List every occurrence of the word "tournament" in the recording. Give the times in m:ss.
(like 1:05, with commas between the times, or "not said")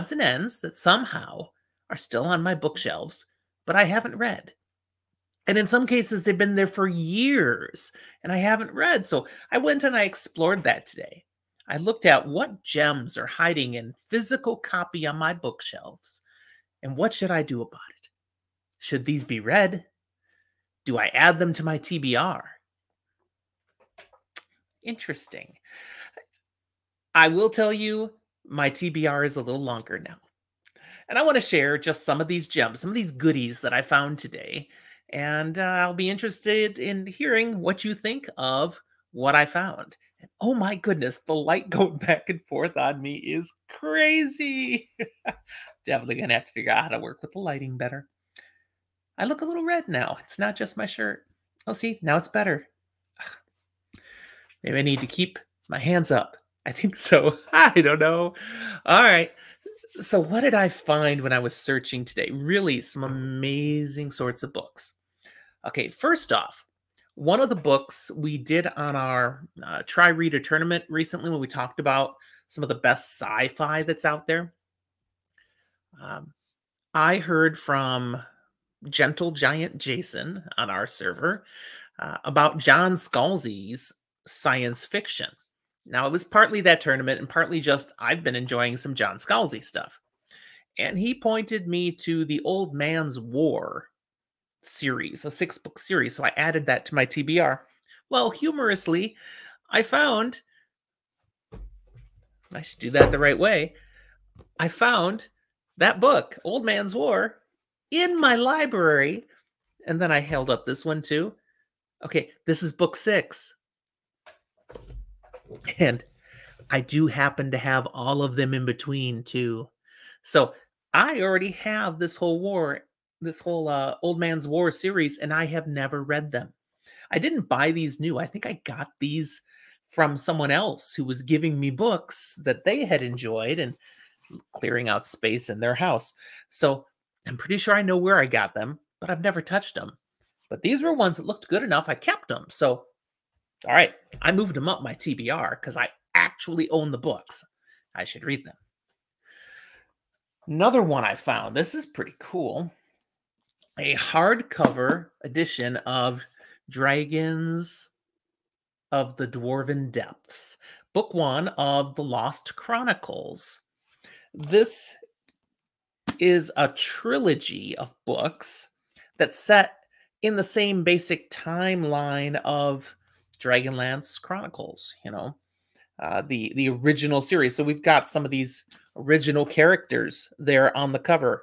1:10, 1:26.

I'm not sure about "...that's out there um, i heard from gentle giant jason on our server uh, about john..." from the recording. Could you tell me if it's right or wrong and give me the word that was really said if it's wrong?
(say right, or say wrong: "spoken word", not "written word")
right.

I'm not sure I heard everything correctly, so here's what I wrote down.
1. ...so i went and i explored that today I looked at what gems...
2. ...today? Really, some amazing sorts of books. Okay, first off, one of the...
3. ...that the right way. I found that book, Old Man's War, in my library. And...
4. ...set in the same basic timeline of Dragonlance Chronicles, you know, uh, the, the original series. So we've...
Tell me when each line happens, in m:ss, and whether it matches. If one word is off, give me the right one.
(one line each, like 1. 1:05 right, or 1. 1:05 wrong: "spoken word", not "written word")
1. 0:09 right
2. 1:02 right
3. 1:42 right
4. 2:49 right.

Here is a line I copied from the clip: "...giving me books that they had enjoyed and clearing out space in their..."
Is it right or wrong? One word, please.
right.